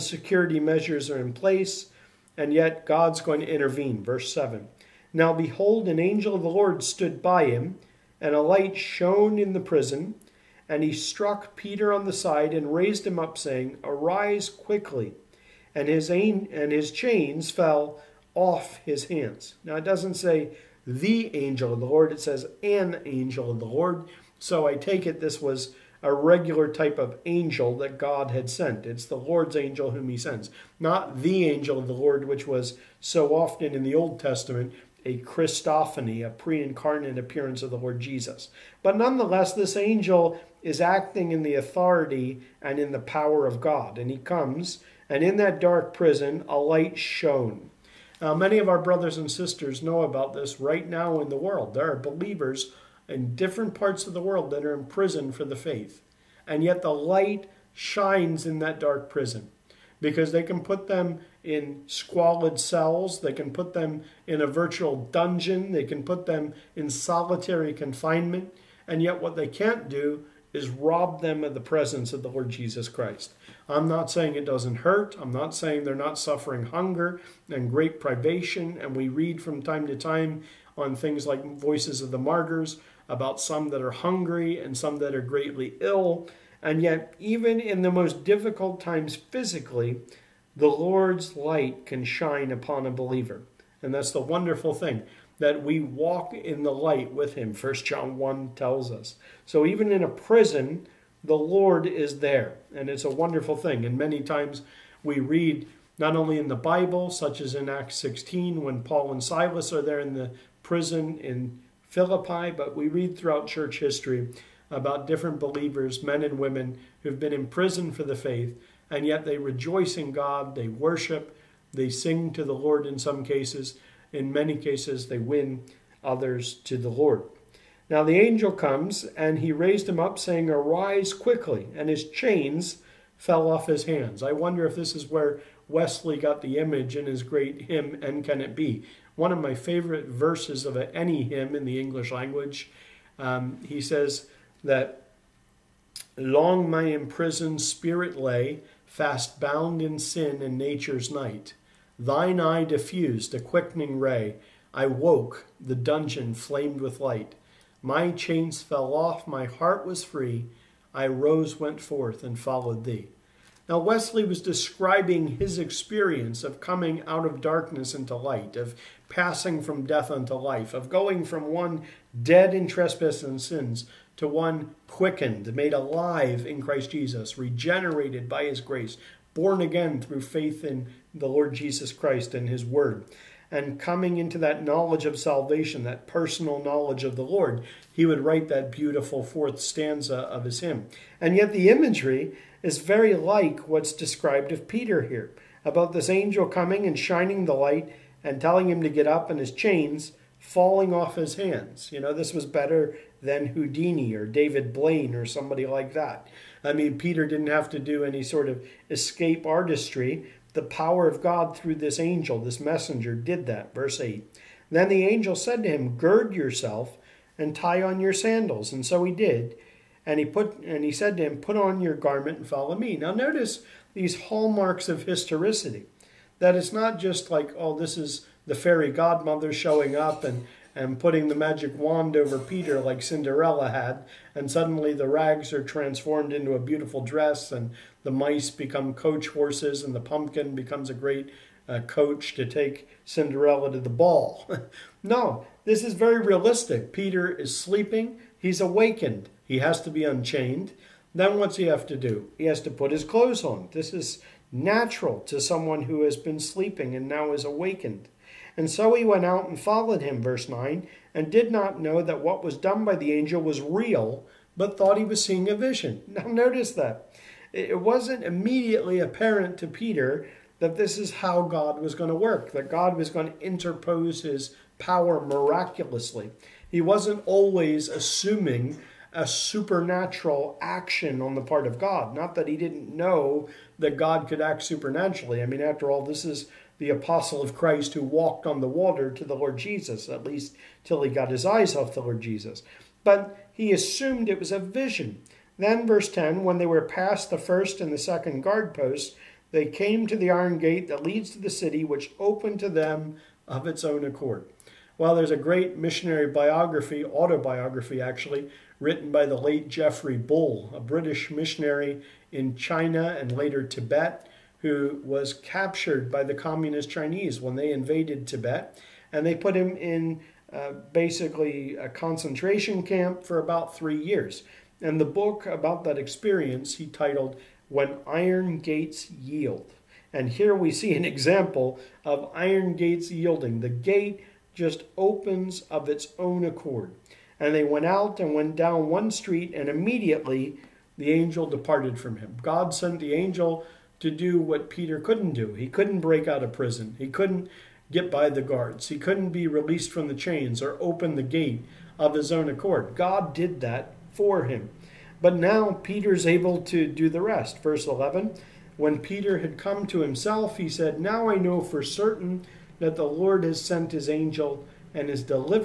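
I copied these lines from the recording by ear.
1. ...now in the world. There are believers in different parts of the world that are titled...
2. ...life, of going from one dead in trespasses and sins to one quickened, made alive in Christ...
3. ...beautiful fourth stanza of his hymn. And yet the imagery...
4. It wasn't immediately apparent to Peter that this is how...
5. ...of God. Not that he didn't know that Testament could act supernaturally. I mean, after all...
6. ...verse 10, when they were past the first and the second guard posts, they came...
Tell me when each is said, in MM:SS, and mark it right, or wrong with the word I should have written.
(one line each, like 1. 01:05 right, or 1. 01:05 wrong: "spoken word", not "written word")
1. 00:50 wrong: "imprisoned", not "titled"
2. 02:50 right
3. 03:08 right
4. 04:27 right
5. 04:41 wrong: "God", not "Testament"
6. 04:55 right.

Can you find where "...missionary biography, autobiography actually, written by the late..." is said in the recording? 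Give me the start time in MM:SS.
05:05.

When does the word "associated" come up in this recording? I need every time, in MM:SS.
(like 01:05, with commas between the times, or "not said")
not said.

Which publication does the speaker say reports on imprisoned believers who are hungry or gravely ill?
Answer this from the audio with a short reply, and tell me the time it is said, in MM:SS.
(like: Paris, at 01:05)
Voices of the Martyrs, at 01:21.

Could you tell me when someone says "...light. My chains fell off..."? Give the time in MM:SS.
02:37.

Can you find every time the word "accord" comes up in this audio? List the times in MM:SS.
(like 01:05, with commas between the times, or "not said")
05:04, 05:36, 05:52.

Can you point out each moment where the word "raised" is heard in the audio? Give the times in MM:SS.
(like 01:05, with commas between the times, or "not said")
00:12, 02:09.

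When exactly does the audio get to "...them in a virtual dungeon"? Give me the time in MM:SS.
01:03.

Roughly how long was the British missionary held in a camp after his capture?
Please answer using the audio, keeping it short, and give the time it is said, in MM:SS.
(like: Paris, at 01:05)
about 3 years, at 05:23.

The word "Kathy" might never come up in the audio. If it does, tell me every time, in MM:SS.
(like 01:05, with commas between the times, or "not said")
not said.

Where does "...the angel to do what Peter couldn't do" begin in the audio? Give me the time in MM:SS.
05:42.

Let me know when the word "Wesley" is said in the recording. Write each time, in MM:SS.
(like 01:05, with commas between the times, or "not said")
02:15, 02:43.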